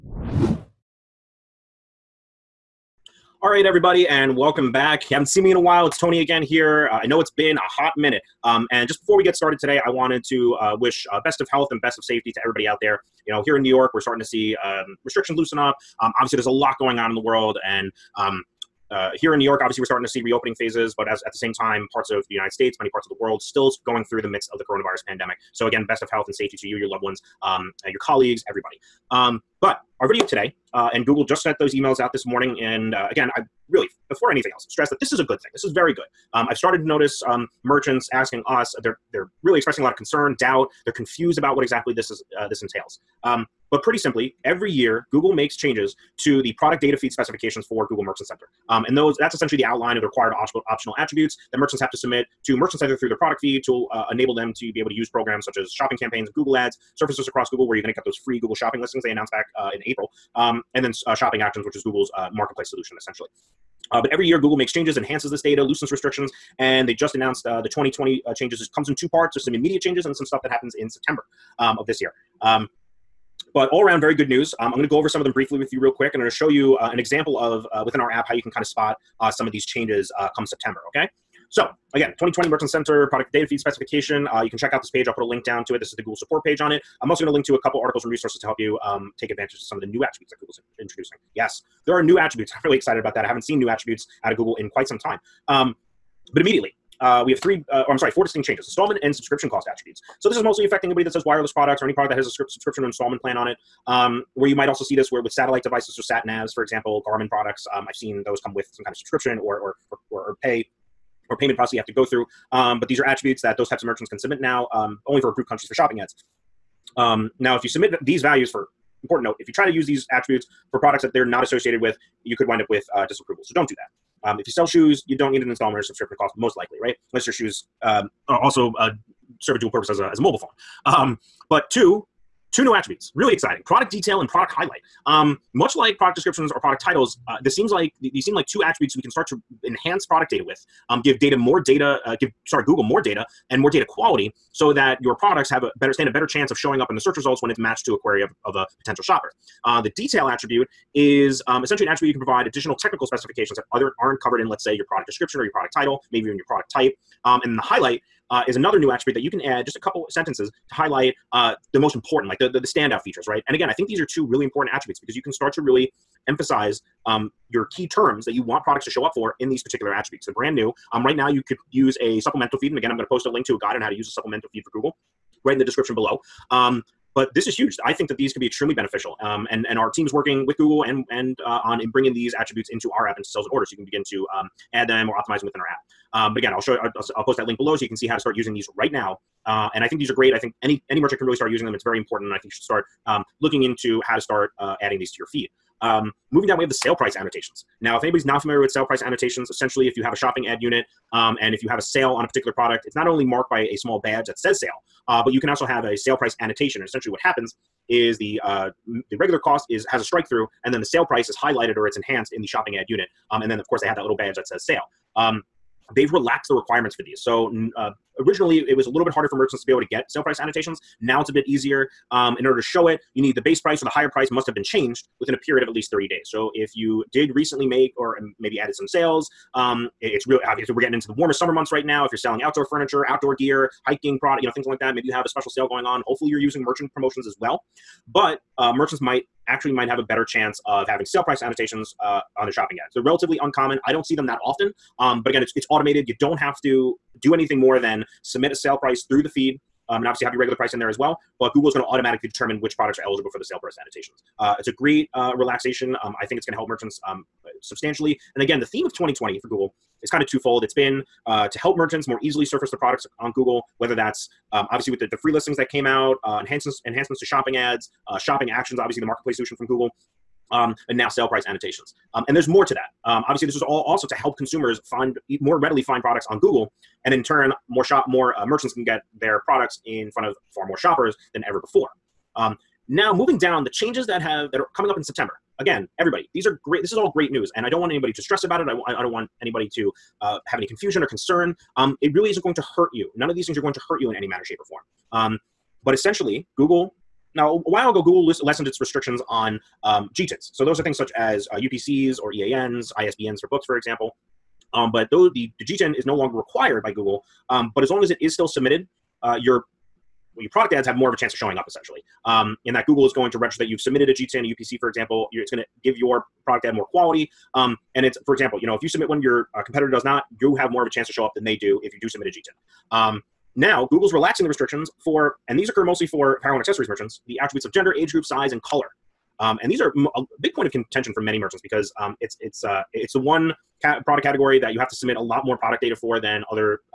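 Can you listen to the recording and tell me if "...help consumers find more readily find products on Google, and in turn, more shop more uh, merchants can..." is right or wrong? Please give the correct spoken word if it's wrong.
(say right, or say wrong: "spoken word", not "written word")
right.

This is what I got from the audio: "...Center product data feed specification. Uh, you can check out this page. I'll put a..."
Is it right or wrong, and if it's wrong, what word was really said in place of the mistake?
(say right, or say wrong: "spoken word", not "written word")
right.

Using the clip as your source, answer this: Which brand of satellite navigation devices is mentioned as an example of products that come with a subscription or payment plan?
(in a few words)
Garmin.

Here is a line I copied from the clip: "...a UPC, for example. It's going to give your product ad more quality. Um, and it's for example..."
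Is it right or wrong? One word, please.
right.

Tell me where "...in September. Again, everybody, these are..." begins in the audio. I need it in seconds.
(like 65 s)
284 s.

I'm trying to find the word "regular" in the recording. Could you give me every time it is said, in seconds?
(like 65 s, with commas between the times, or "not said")
209 s, 250 s.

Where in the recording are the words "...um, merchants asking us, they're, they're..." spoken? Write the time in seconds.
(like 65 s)
37 s.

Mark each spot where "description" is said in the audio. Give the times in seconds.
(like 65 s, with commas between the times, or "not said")
136 s, 155 s, 175 s.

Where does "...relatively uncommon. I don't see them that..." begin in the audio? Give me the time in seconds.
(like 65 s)
243 s.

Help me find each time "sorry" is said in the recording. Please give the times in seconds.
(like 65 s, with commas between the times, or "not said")
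97 s, 142 s.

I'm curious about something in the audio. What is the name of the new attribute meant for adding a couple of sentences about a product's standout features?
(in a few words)
product highlight.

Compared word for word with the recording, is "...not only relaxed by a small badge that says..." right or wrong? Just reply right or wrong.
wrong.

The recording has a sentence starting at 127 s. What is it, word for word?
Unless your shoes um, are also uh, serve a dual purpose as a, as a mobile phone.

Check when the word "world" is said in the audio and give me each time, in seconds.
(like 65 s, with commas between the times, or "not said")
17 s, 23 s.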